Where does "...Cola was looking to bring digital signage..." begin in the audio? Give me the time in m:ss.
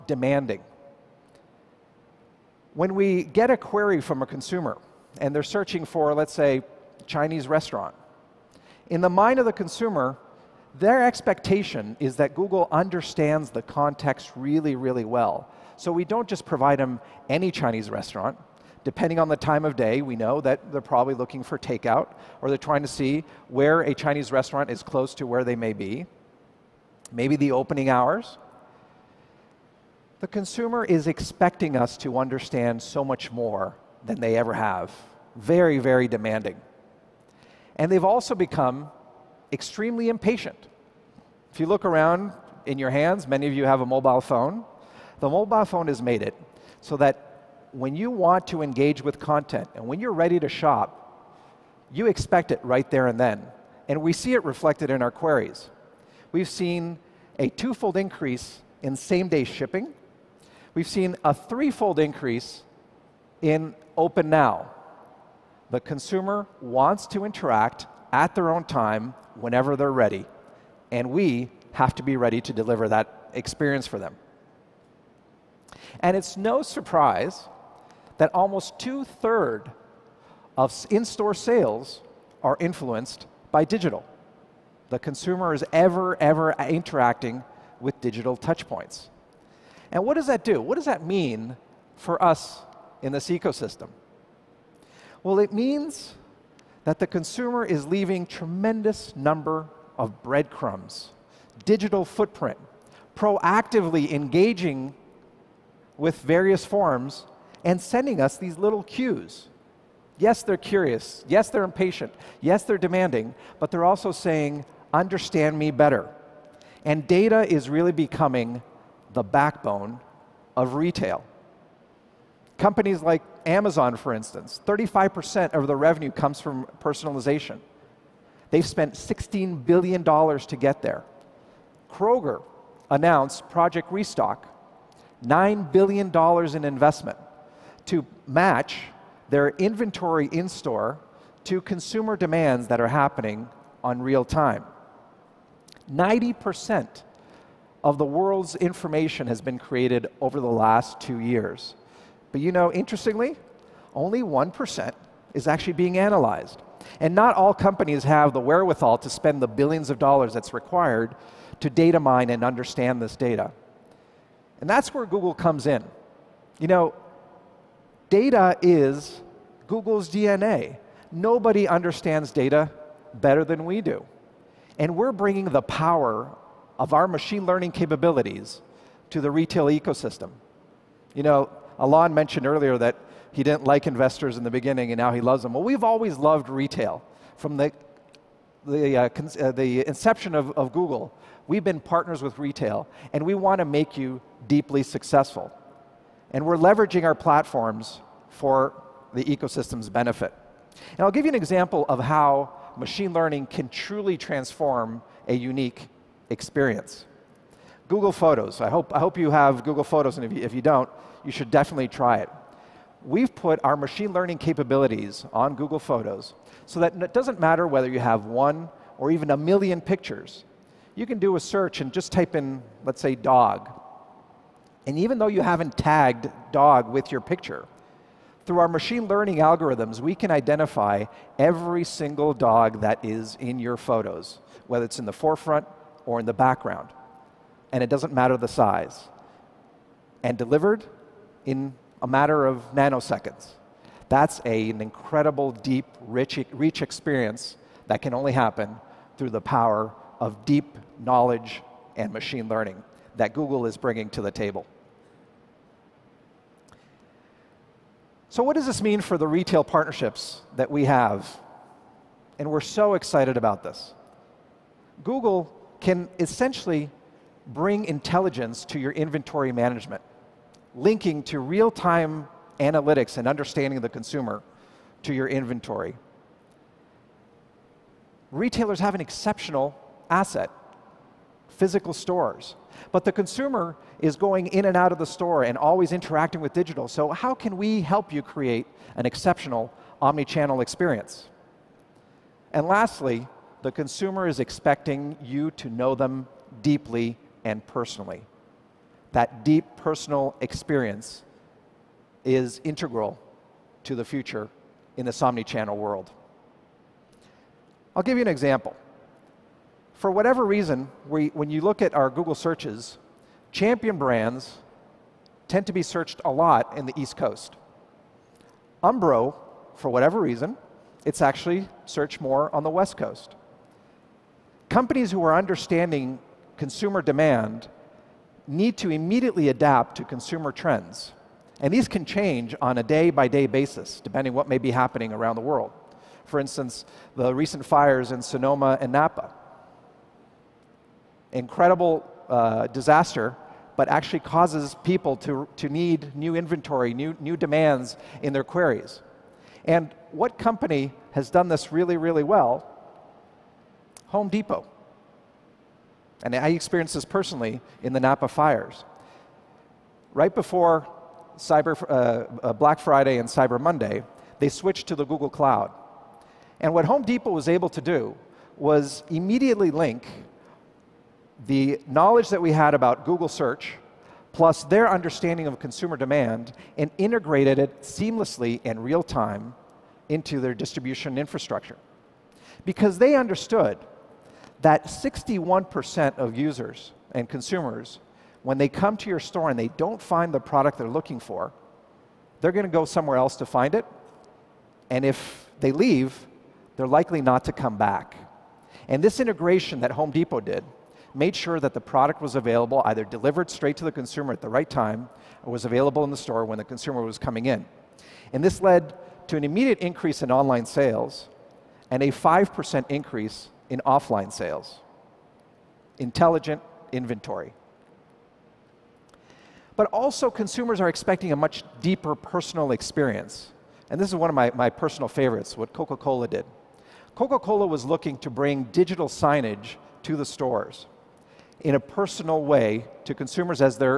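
7:07.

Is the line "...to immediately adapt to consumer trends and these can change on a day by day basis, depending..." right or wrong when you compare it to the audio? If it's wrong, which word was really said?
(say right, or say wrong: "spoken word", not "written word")
right.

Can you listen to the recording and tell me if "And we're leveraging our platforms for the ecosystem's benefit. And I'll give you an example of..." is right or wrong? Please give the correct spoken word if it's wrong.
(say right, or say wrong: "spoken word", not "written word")
right.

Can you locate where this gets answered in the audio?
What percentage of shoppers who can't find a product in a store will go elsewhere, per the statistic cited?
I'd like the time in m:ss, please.
6:24.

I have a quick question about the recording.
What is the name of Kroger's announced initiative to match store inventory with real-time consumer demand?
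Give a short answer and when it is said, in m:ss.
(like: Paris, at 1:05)
Project Restock, at 2:13.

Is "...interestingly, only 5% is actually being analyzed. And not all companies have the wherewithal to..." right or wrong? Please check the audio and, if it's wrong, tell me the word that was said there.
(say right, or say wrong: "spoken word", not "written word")
wrong: "1", not "5".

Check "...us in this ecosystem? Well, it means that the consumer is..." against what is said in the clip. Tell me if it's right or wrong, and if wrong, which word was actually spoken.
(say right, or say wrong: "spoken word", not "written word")
right.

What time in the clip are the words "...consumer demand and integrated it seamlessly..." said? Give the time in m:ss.
6:15.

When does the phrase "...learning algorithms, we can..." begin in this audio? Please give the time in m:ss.
3:49.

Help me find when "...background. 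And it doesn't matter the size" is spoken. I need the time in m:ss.
3:56.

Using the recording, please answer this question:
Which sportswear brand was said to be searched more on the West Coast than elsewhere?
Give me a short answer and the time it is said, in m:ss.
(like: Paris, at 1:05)
Umbro, at 5:18.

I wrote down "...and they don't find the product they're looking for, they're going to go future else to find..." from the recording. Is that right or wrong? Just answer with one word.
wrong.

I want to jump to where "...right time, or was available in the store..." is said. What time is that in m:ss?
6:44.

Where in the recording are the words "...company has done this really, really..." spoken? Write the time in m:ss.
5:50.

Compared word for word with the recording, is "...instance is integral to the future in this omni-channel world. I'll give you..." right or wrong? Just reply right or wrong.
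wrong.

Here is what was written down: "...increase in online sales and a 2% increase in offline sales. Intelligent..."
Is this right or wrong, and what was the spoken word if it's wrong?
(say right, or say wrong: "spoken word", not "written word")
wrong: "5", not "2".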